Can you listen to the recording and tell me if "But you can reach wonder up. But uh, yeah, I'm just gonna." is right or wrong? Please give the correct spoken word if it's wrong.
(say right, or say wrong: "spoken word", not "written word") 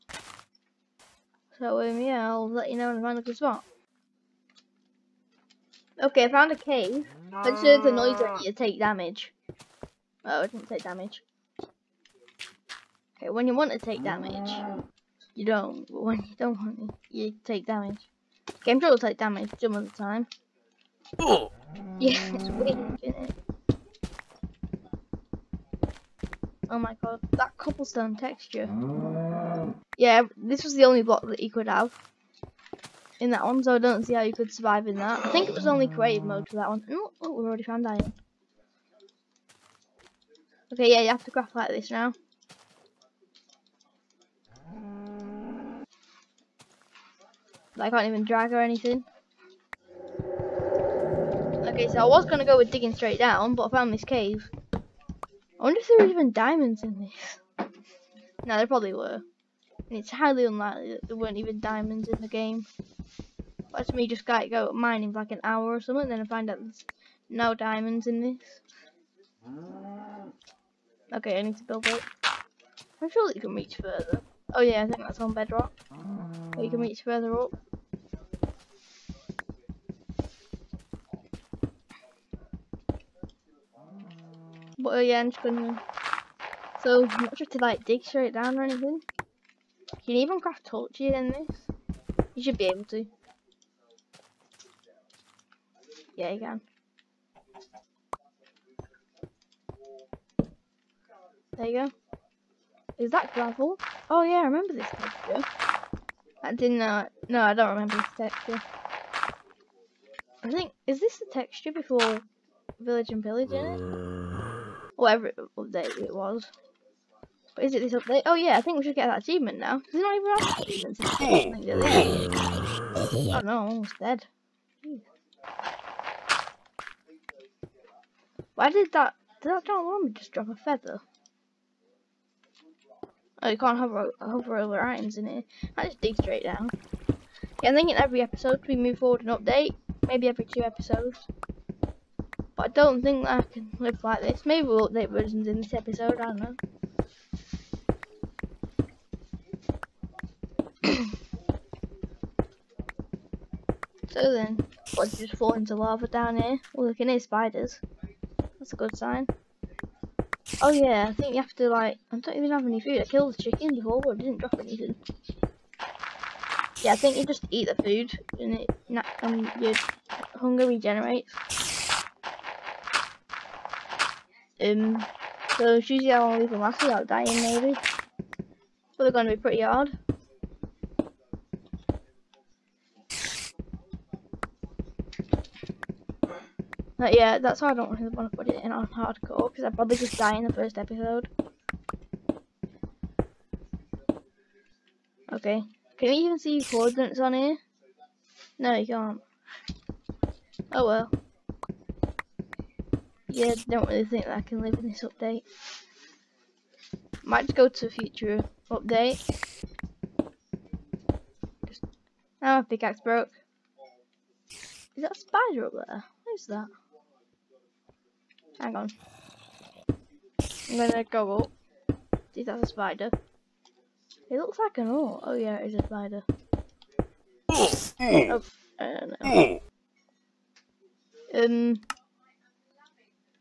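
wrong: "further", not "wonder".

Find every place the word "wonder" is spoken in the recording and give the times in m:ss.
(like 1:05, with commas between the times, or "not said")
0:55.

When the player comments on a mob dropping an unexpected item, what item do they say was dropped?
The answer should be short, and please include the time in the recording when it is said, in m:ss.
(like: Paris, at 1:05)
a feather, at 2:10.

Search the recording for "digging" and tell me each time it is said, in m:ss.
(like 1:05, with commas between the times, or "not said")
0:52.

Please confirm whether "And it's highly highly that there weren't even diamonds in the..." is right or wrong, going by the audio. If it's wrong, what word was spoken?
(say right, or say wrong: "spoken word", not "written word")
wrong: "unlikely", not "highly".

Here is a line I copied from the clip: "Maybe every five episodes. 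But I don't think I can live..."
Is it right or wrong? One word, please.
wrong.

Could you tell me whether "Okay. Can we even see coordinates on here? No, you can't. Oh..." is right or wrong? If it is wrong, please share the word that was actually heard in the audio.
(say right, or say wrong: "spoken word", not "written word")
right.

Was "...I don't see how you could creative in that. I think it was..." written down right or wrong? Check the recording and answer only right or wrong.
wrong.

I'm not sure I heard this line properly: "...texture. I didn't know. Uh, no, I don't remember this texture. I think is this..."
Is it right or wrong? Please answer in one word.
right.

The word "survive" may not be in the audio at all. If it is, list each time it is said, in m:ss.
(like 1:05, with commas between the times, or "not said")
0:34.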